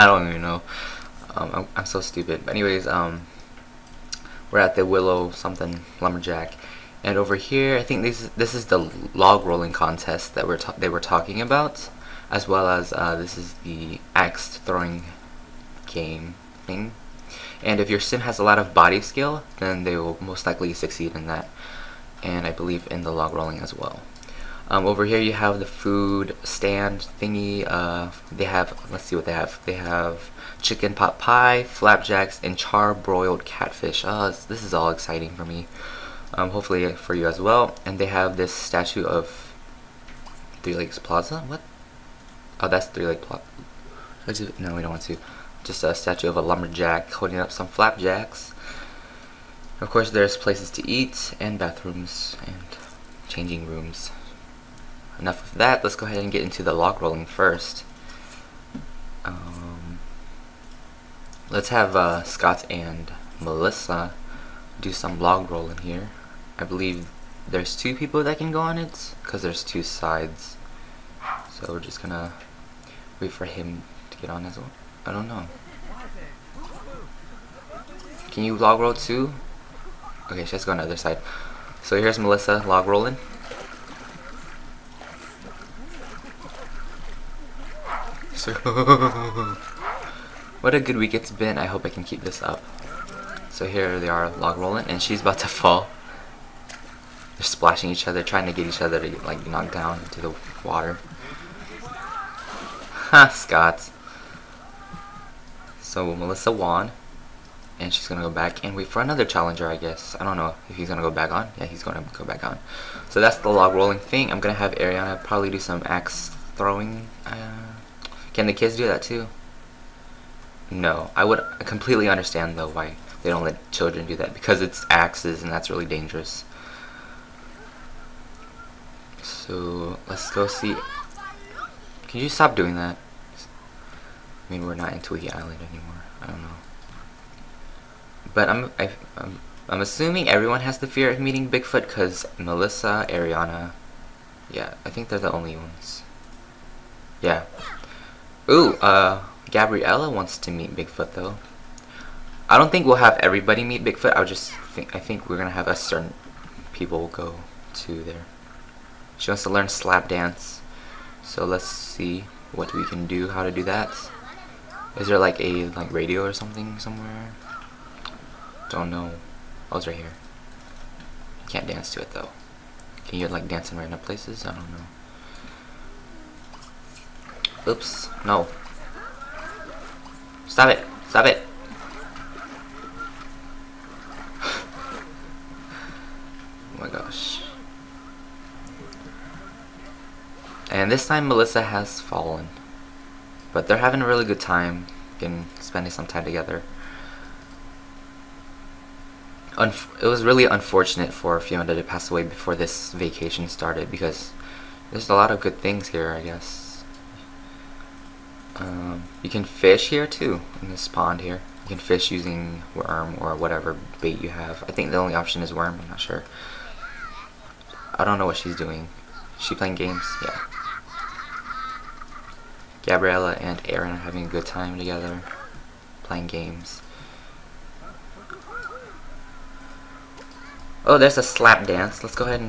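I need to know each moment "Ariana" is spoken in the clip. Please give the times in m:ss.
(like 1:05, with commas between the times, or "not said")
1:54, 2:23.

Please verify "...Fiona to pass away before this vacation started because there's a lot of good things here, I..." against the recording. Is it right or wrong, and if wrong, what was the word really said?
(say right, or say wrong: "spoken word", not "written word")
right.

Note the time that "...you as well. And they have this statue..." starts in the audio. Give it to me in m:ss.
0:37.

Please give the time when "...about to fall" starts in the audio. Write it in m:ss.
1:35.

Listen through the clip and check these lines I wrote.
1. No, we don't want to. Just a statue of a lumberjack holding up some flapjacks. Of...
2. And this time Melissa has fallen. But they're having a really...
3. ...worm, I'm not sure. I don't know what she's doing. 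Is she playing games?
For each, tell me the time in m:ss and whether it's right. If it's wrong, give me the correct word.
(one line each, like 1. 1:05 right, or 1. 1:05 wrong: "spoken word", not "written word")
1. 0:44 right
2. 3:10 right
3. 3:35 right.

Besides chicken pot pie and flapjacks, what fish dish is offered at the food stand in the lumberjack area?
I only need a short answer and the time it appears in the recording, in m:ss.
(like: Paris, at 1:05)
Char-broiled catfish, at 0:32.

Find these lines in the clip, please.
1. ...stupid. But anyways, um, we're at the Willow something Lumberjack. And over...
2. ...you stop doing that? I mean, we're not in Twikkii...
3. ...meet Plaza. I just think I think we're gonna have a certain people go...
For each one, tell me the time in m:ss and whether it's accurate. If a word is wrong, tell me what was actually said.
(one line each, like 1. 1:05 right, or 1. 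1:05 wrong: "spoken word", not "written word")
1. 0:01 right
2. 2:12 right
3. 2:33 wrong: "Bigfoot", not "Plaza".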